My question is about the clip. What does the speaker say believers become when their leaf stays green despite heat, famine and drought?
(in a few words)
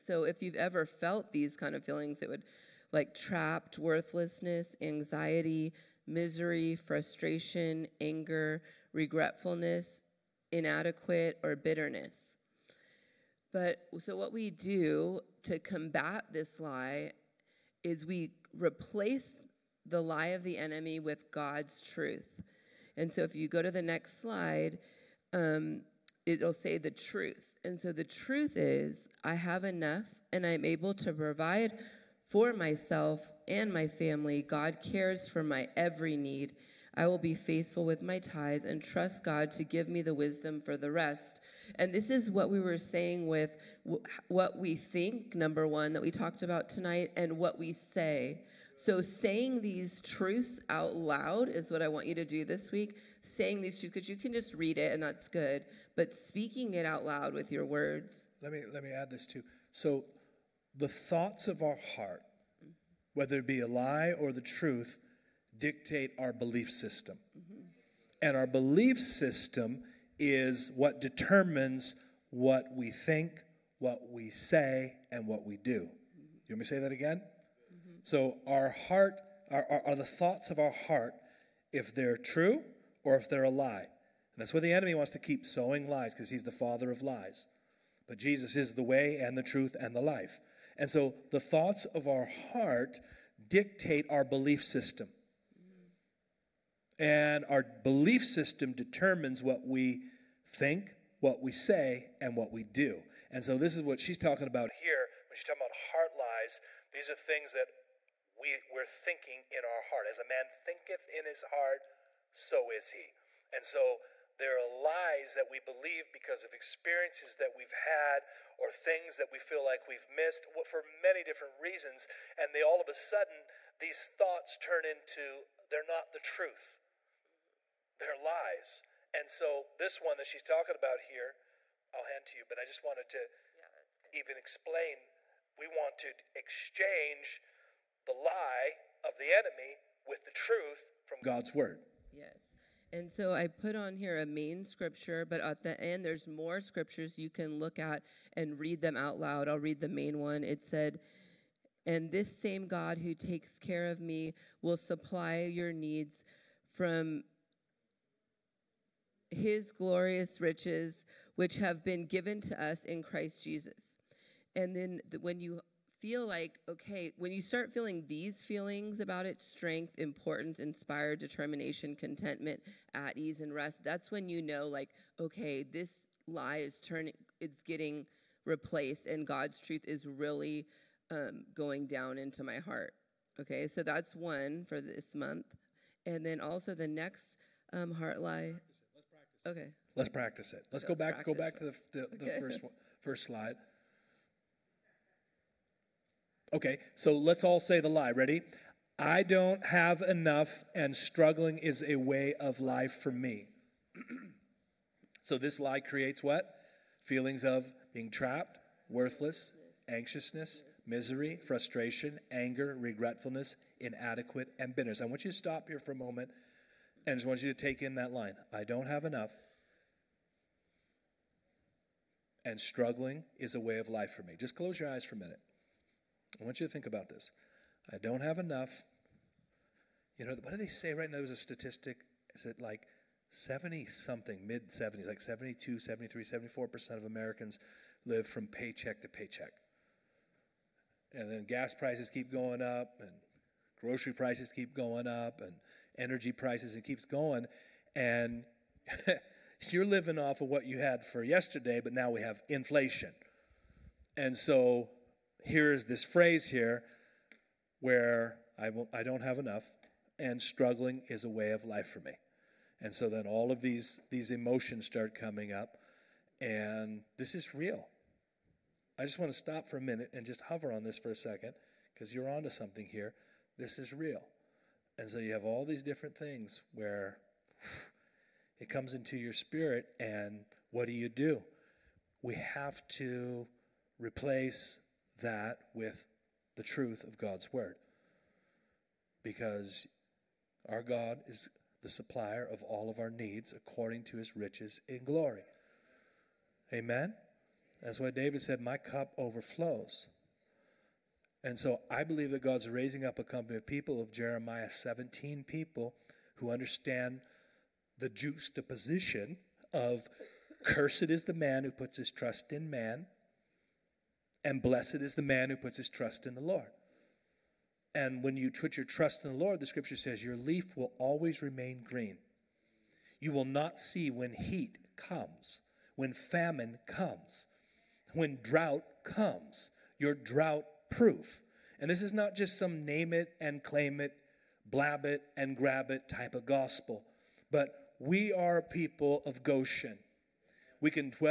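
Drought proof.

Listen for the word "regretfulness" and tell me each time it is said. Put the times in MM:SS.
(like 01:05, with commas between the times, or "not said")
00:08, 03:32.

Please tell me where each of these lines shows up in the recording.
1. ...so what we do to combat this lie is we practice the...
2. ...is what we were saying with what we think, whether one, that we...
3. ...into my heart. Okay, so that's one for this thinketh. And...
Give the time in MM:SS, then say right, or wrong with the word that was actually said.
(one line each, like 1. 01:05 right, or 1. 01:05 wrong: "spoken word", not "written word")
1. 00:13 wrong: "replace", not "practice"
2. 00:42 wrong: "number", not "whether"
3. 03:02 wrong: "month", not "thinketh".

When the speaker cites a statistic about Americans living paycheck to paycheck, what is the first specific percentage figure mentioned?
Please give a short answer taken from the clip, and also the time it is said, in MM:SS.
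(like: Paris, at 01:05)
72%, at 03:55.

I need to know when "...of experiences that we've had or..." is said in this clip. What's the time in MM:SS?
01:56.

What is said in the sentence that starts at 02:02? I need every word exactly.
And they all of a sudden, these thoughts turn into they're not the truth, they're lies.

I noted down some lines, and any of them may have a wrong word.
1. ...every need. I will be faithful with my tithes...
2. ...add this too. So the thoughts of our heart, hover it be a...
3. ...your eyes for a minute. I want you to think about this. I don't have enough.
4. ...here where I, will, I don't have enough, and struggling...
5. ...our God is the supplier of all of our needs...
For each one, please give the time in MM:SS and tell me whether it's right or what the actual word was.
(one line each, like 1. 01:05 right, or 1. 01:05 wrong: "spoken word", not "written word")
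1. 00:35 right
2. 00:58 wrong: "whether", not "hover"
3. 03:44 right
4. 04:16 right
5. 04:50 right.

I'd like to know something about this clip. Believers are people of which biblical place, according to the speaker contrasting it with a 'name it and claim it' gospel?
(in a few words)
Goshen.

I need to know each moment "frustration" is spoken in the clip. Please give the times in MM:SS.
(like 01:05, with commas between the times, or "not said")
00:06, 03:31.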